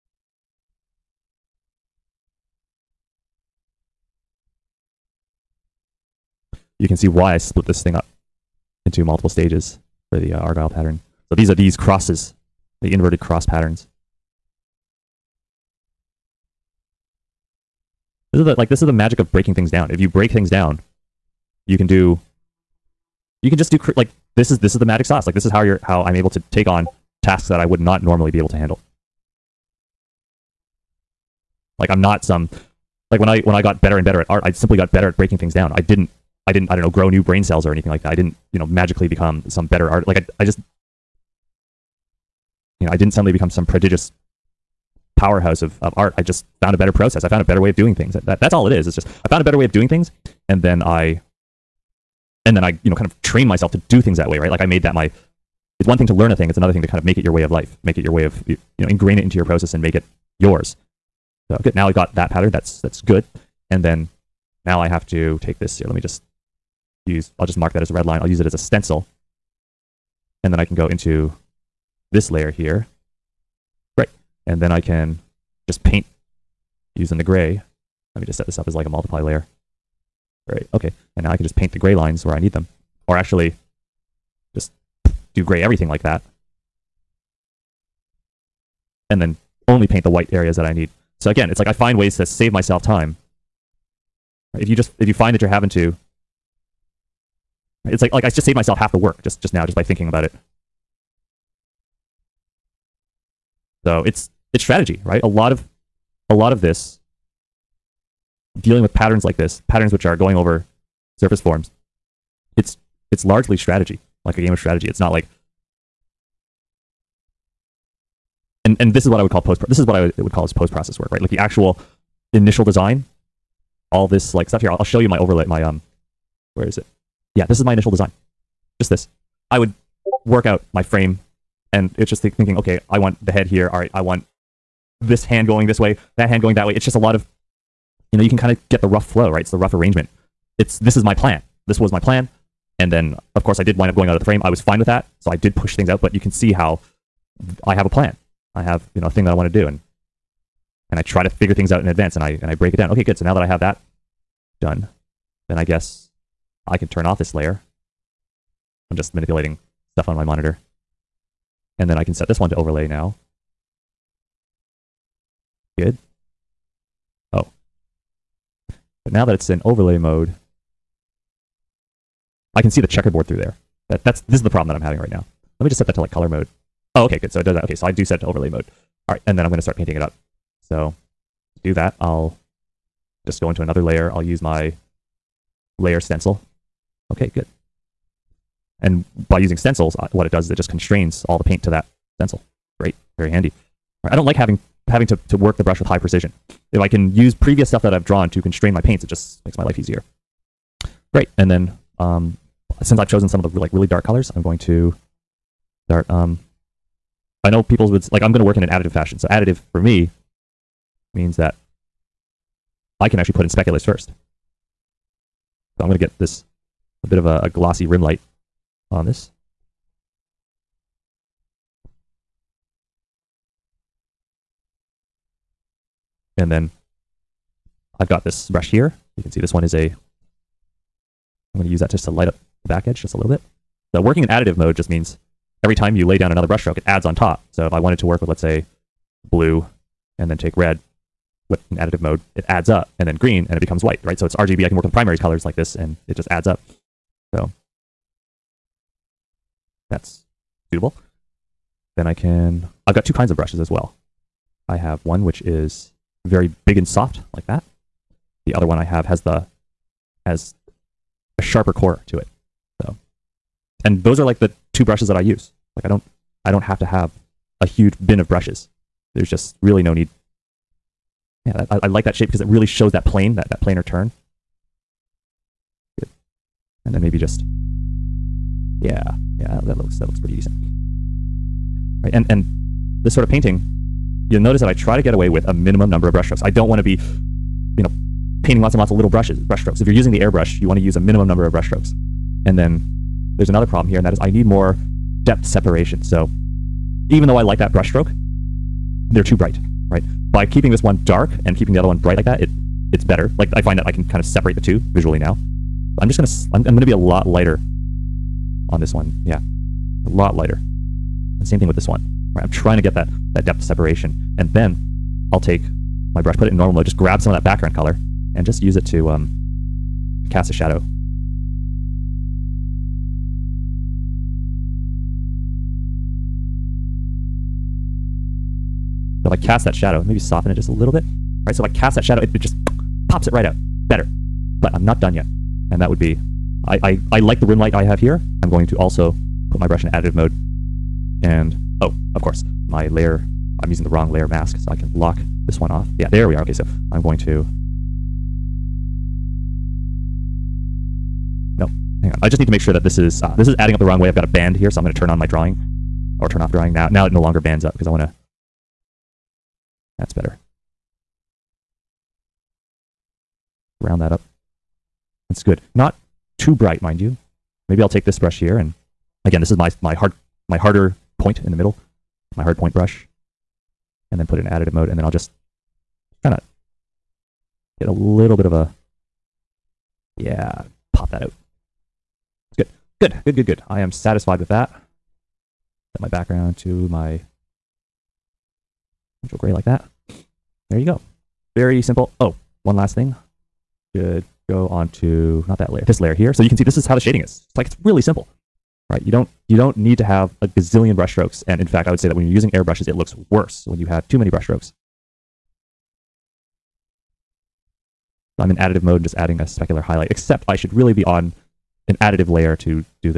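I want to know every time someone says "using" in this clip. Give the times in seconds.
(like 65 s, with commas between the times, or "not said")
76 s, 189 s, 289 s, 343 s, 402 s.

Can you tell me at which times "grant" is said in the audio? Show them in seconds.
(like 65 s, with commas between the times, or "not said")
not said.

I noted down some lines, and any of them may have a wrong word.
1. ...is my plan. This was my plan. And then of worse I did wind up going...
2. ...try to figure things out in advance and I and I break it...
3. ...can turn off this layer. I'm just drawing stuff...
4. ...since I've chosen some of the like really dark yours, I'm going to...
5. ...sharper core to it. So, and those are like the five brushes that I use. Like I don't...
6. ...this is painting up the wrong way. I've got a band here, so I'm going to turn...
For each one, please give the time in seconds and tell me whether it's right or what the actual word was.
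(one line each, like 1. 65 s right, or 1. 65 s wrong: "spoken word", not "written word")
1. 140 s wrong: "course", not "worse"
2. 151 s right
3. 156 s wrong: "manipulating", not "drawing"
4. 202 s wrong: "colors", not "yours"
5. 261 s wrong: "two", not "five"
6. 353 s wrong: "adding", not "painting".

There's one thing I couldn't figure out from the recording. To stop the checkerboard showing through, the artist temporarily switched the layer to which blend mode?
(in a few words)
color mode.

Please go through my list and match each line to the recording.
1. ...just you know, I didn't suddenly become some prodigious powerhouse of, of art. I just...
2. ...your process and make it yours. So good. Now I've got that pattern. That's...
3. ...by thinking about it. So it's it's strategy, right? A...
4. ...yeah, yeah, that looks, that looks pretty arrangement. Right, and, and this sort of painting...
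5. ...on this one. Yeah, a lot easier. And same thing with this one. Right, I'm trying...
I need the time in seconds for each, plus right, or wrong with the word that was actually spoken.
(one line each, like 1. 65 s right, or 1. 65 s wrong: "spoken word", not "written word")
1. 40 s right
2. 59 s right
3. 99 s right
4. 278 s wrong: "decent", not "arrangement"
5. 308 s wrong: "lighter", not "easier".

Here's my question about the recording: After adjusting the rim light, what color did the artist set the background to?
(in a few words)
neutral gray.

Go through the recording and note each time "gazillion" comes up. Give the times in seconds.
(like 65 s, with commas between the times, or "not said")
400 s.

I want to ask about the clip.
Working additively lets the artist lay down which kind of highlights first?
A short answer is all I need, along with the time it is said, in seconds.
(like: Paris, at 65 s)
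speculars, at 213 s.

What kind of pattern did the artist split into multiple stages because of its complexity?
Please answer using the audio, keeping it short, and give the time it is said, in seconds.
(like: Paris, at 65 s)
Argyle, at 10 s.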